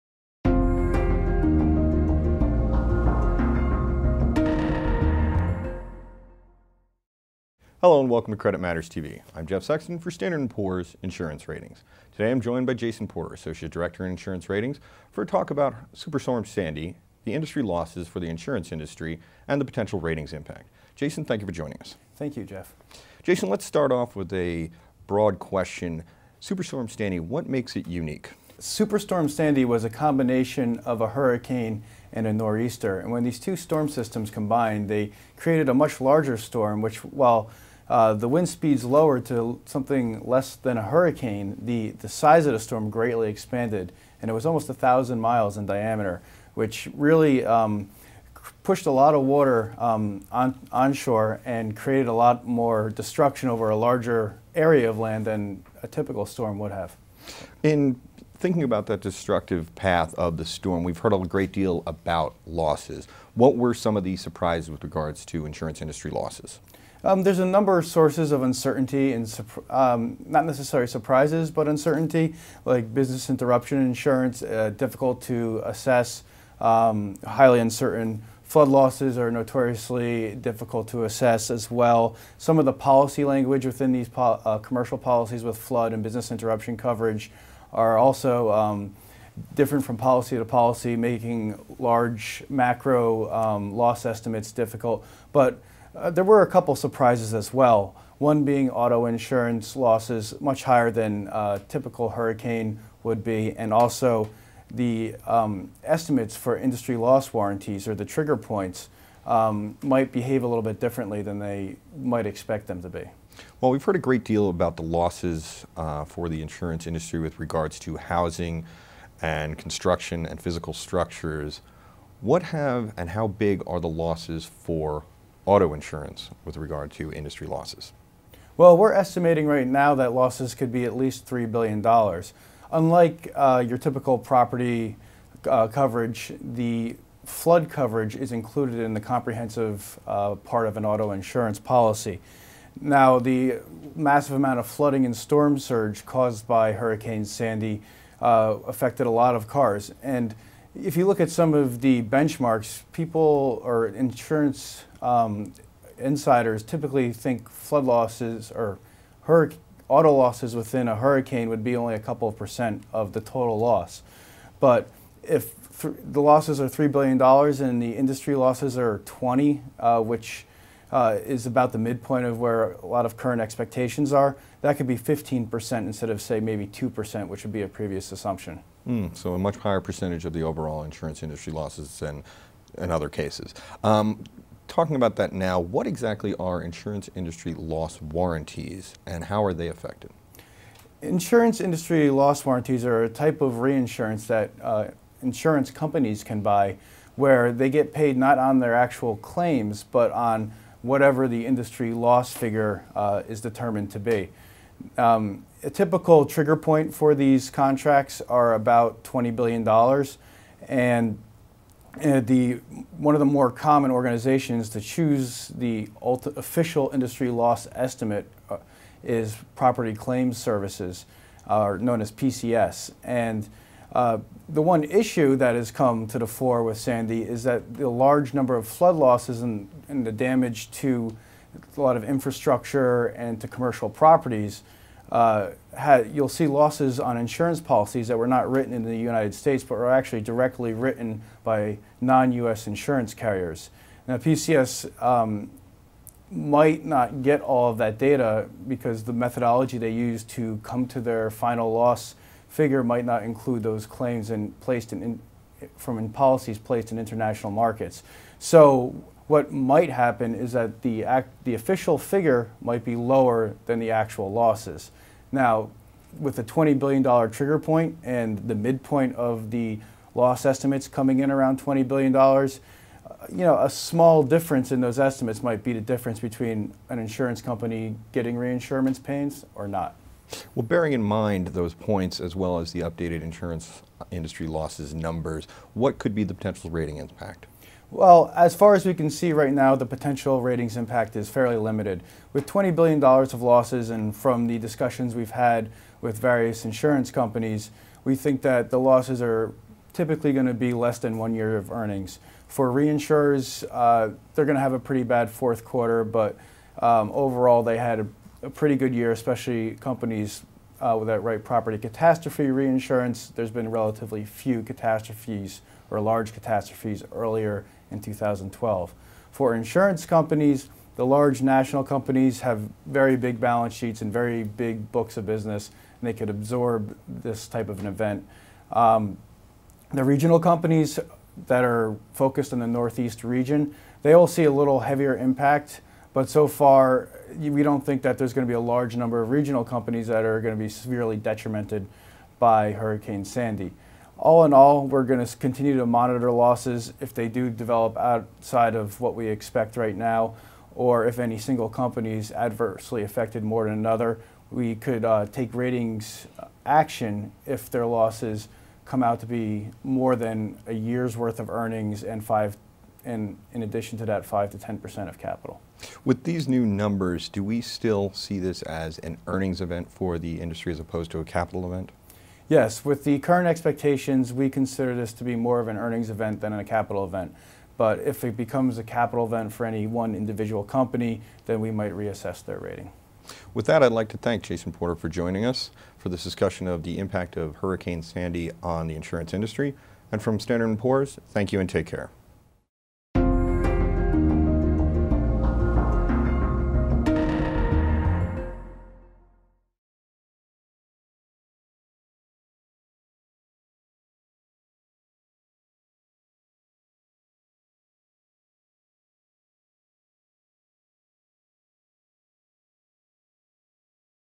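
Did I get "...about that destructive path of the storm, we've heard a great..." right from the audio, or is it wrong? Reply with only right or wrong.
right.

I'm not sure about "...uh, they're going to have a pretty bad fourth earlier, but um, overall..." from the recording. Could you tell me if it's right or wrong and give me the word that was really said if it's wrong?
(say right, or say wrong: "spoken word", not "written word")
wrong: "quarter", not "earlier".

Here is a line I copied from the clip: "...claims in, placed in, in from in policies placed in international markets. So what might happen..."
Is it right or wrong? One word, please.
right.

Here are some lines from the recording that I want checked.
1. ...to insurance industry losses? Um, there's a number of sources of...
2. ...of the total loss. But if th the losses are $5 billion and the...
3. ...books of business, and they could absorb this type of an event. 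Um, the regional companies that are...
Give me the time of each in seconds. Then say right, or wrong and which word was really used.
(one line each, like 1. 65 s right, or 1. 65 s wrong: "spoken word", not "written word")
1. 65 s right
2. 162 s wrong: "3", not "5"
3. 324 s right.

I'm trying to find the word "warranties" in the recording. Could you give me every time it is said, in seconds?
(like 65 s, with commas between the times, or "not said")
107 s, 188 s, 192 s.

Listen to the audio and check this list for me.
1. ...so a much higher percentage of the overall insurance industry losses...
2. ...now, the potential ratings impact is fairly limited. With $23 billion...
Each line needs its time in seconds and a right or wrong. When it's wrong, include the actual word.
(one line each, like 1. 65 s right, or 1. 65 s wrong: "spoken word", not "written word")
1. 179 s right
2. 289 s wrong: "20", not "23".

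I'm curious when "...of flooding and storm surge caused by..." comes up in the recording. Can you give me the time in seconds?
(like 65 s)
144 s.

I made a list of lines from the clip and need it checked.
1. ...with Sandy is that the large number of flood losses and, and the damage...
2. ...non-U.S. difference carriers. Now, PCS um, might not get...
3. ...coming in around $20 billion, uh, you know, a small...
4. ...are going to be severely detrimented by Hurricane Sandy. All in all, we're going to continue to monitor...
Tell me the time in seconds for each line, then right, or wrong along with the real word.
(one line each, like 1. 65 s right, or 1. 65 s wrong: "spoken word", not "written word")
1. 226 s right
2. 241 s wrong: "insurance", not "difference"
3. 270 s right
4. 340 s right.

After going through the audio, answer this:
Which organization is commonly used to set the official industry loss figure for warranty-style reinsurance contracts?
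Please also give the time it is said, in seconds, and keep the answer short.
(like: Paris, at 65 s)
Property Claims Services, at 219 s.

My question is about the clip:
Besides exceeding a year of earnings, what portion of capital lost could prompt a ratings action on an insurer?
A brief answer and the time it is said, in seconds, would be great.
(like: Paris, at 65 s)
5 to 10%, at 364 s.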